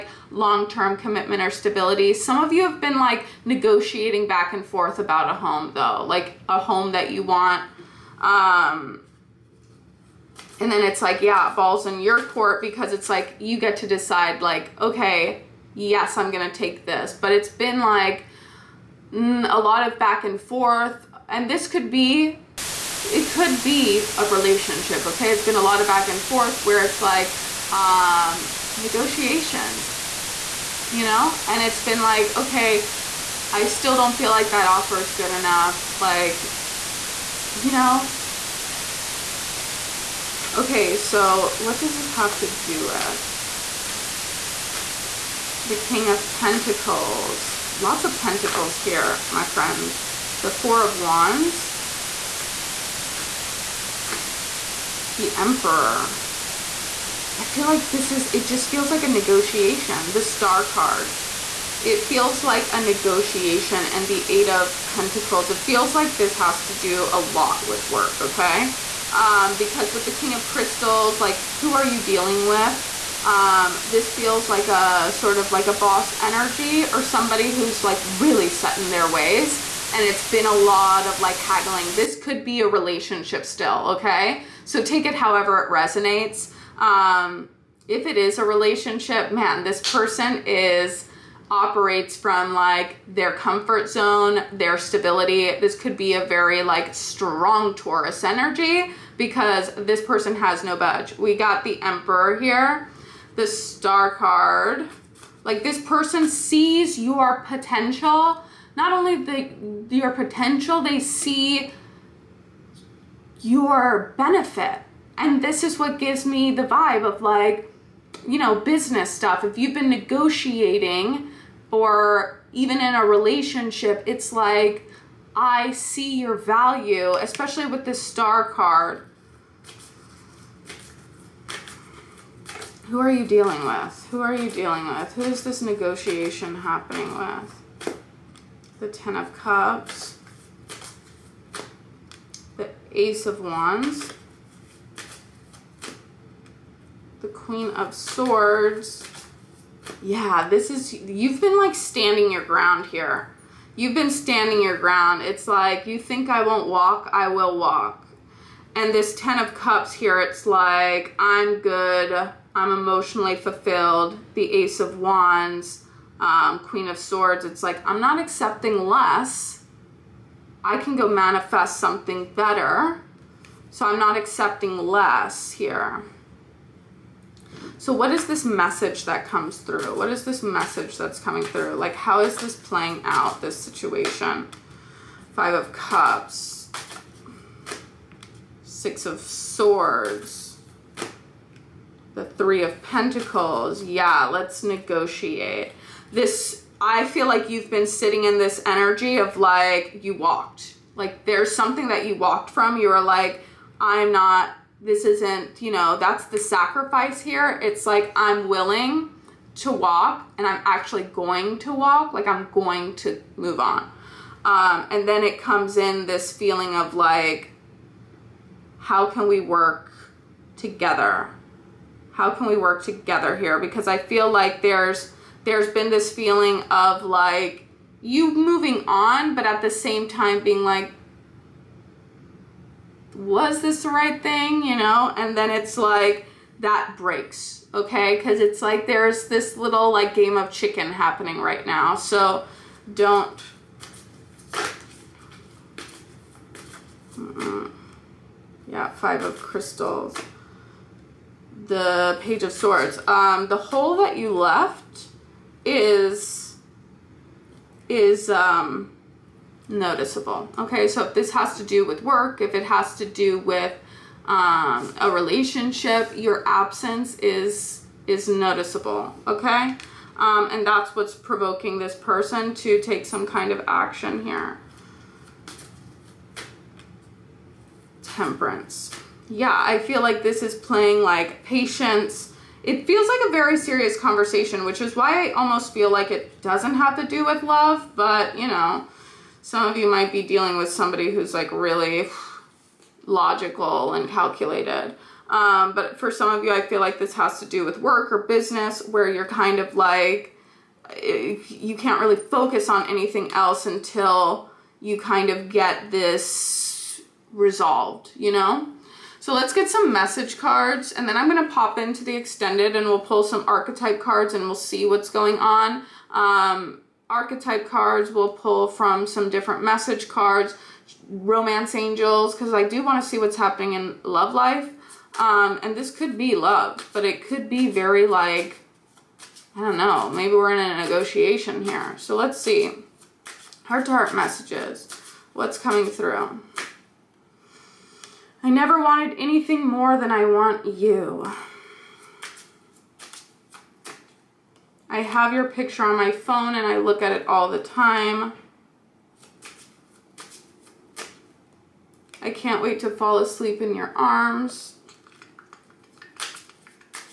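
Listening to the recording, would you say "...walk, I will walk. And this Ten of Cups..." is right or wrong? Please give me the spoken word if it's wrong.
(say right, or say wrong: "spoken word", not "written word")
right.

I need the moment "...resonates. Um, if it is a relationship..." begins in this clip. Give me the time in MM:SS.
01:25.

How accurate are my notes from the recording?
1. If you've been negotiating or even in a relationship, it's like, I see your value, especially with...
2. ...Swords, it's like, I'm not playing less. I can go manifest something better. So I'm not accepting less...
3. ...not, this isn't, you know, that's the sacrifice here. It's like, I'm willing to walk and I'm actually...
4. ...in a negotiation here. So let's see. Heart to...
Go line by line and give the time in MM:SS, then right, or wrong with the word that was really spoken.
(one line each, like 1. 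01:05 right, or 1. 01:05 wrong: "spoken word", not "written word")
1. 01:59 right
2. 02:46 wrong: "accepting", not "playing"
3. 03:24 right
4. 05:30 right.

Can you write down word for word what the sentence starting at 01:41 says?
We got the Emperor here, the Star card.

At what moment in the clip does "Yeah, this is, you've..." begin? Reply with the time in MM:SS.
02:30.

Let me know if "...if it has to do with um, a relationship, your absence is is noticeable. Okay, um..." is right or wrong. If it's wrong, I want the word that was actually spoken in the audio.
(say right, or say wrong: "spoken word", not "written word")
right.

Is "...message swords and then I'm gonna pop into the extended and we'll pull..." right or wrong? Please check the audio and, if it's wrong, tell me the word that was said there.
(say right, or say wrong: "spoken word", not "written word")
wrong: "cards", not "swords".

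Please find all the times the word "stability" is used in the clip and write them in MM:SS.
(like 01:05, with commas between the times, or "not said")
00:01, 01:34.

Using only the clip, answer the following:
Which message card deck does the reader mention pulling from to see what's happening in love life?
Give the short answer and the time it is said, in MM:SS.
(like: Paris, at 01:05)
Romance Angels, at 05:21.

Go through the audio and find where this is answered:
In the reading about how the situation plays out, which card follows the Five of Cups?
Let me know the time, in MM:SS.
03:08.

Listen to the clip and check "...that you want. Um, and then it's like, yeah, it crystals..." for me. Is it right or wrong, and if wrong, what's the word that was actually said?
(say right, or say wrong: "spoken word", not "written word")
wrong: "falls", not "crystals".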